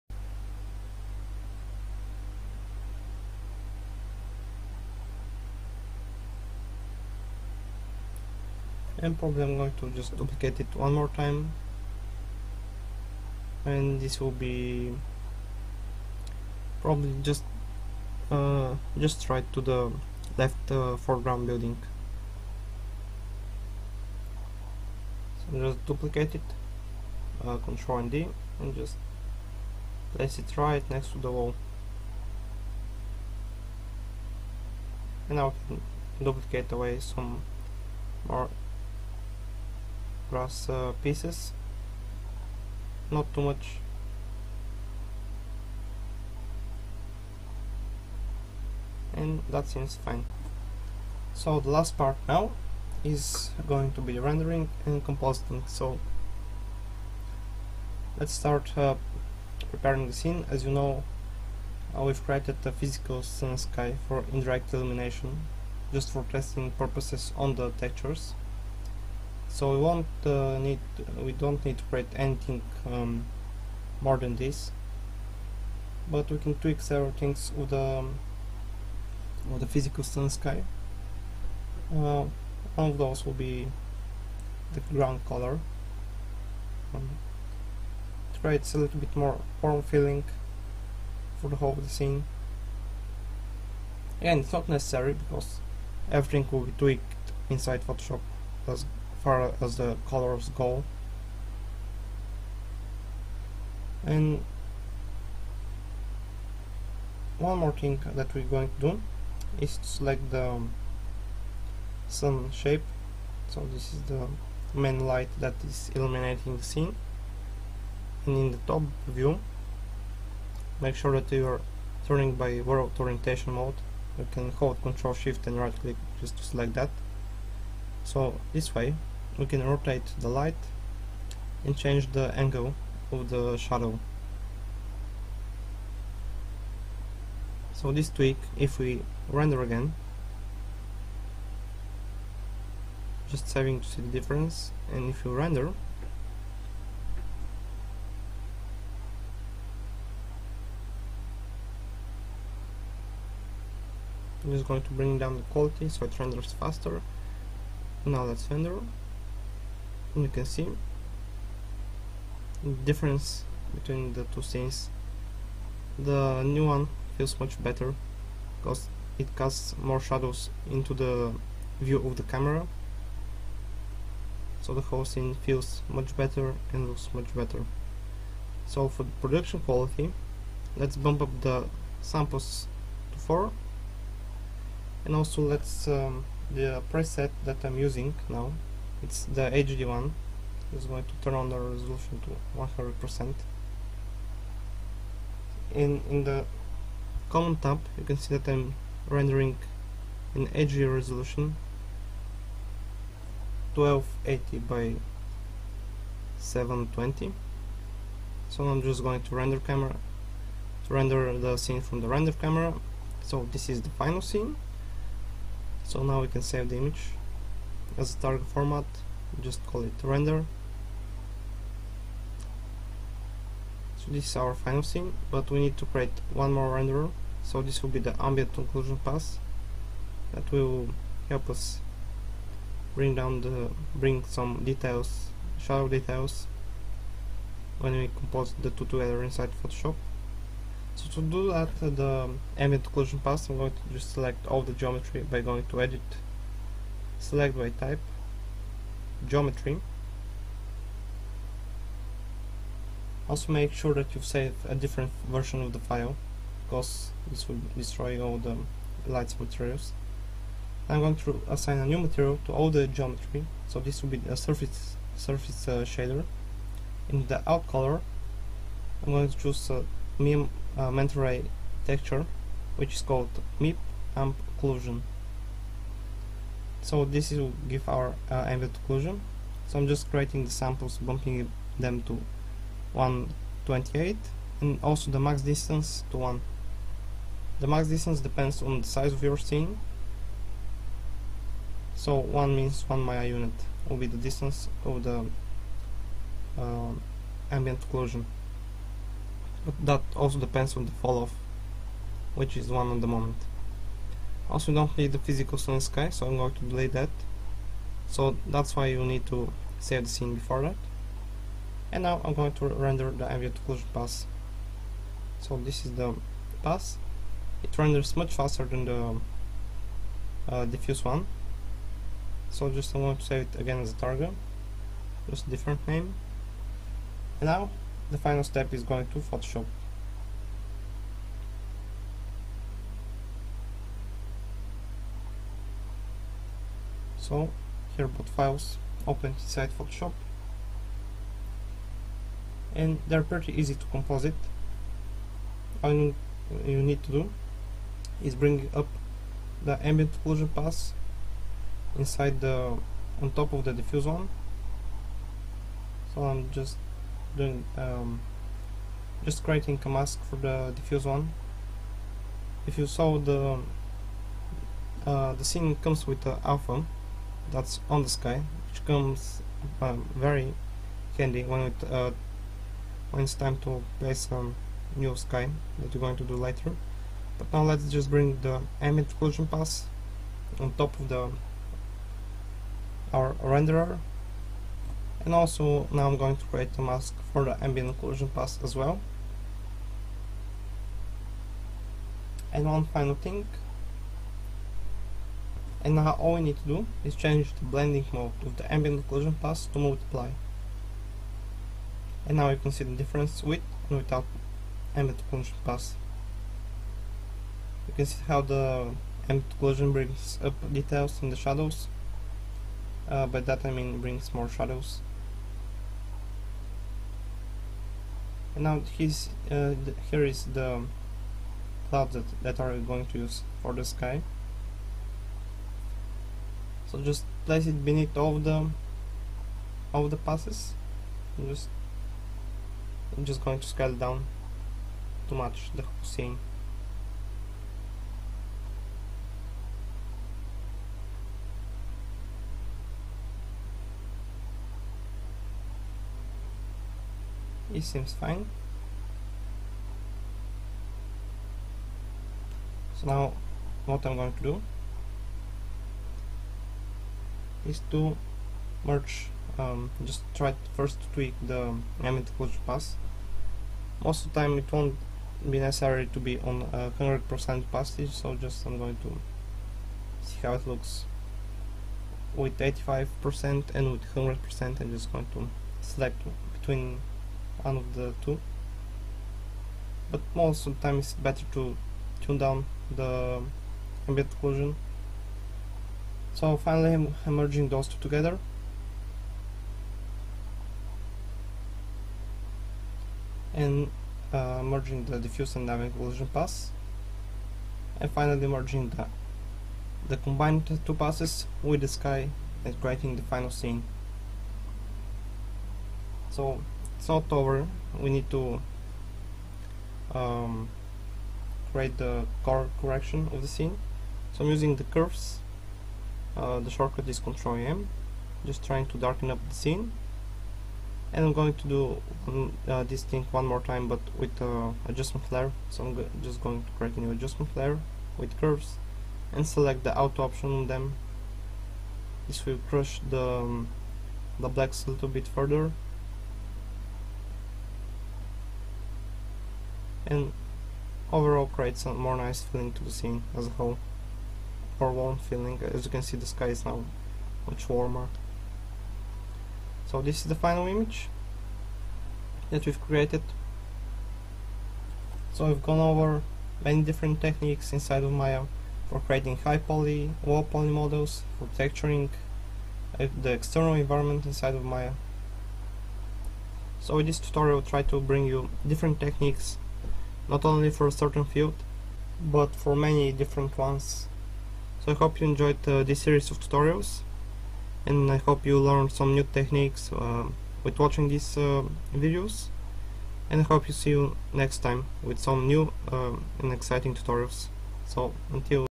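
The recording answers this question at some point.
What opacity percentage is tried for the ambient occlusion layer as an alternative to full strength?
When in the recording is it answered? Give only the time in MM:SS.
07:52.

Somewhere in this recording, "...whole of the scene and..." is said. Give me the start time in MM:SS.
01:31.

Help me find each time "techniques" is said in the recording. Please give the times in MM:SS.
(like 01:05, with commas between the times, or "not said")
09:17, 09:28, 09:39.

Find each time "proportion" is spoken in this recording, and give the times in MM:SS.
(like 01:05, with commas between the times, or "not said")
not said.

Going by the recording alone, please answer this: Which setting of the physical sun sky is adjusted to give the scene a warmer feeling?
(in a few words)
ground color.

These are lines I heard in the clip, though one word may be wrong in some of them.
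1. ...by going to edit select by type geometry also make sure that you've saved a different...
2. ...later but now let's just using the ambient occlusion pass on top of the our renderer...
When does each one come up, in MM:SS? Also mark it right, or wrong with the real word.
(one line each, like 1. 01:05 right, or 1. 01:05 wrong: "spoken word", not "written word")
1. 04:05 right
2. 06:16 wrong: "bring", not "using".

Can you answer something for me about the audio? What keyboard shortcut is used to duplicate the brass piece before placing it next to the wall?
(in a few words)
Control and D.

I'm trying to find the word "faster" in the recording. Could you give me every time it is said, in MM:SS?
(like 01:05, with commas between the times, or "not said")
02:36, 05:18.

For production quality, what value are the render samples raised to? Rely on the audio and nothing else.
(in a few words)
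4.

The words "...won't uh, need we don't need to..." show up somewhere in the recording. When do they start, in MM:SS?
01:09.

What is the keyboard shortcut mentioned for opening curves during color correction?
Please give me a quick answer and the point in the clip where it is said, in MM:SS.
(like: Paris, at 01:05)
Control M, at 08:37.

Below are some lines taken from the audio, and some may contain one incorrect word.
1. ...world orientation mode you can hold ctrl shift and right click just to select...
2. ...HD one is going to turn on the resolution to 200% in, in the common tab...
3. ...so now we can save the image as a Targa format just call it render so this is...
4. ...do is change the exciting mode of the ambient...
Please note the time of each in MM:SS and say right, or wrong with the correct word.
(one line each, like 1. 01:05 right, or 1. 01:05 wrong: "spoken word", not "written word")
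1. 02:02 right
2. 03:09 wrong: "100", not "200"
3. 03:35 right
4. 06:36 wrong: "blending", not "exciting".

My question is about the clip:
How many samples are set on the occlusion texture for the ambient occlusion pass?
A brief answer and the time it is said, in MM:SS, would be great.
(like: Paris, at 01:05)
128, at 04:42.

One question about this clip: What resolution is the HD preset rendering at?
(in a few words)
1280 by 720.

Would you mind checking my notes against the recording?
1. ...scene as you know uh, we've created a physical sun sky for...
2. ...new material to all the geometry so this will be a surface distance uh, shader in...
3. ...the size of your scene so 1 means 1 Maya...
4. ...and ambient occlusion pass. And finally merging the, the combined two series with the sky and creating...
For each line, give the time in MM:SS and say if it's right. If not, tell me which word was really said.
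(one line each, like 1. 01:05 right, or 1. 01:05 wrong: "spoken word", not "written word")
1. 01:00 right
2. 04:21 wrong: "surface", not "distance"
3. 04:48 right
4. 08:15 wrong: "passes", not "series".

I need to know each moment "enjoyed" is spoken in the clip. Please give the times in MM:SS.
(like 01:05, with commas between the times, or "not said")
09:35.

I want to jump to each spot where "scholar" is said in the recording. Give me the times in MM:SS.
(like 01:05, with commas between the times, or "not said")
not said.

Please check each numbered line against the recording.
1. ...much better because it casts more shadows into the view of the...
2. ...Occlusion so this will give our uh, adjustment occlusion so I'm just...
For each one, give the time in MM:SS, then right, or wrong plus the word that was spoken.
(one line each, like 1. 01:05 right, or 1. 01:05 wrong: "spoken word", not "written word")
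1. 02:47 right
2. 04:34 wrong: "ambient", not "adjustment".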